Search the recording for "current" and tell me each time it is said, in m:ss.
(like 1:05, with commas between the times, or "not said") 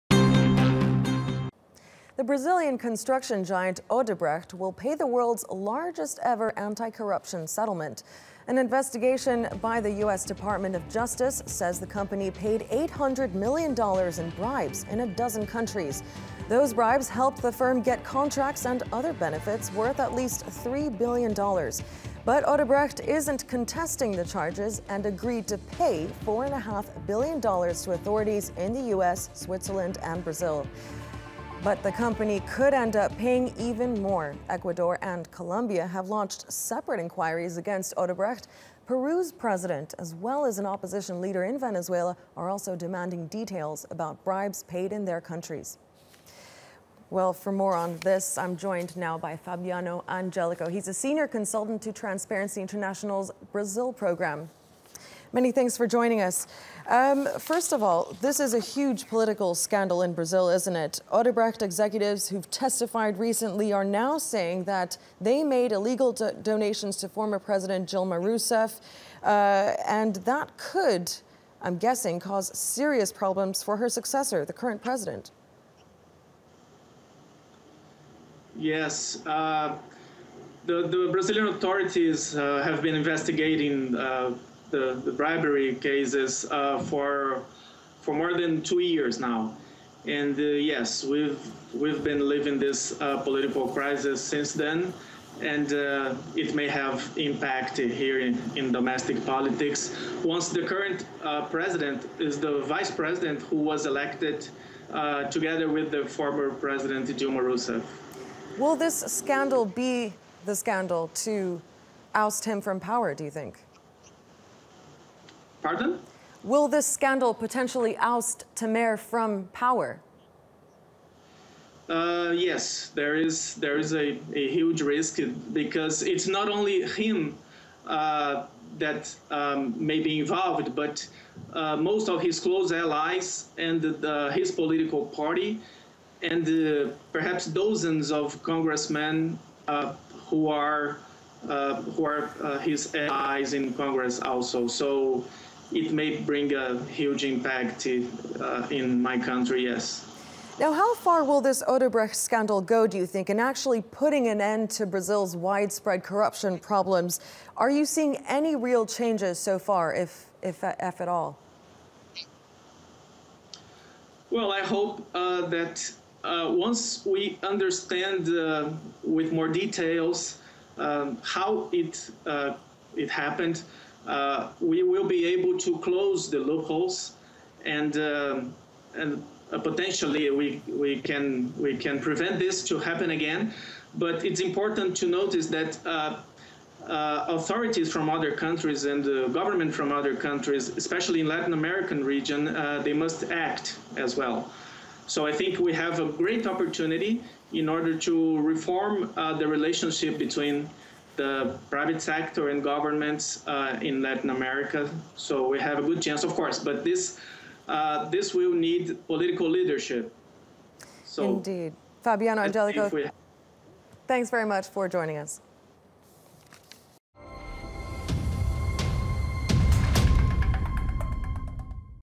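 1:14, 1:40.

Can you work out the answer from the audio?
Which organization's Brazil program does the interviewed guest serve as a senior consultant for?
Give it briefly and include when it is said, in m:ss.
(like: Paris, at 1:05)
Transparency International, at 0:51.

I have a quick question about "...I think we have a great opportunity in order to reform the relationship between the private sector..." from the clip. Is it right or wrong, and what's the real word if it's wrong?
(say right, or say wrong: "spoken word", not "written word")
right.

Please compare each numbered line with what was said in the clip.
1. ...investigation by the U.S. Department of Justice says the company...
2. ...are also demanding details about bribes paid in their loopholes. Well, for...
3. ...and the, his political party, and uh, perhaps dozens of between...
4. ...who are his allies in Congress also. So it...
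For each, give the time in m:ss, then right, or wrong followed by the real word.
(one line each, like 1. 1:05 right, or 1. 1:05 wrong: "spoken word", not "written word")
1. 0:08 right
2. 0:42 wrong: "countries", not "loopholes"
3. 2:13 wrong: "congressmen", not "between"
4. 2:21 right.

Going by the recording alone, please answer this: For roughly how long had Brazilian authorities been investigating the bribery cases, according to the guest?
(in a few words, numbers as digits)
more than 2 years.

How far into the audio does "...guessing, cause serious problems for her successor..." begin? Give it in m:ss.
1:11.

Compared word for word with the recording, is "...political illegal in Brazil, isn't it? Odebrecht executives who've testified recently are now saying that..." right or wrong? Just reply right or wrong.
wrong.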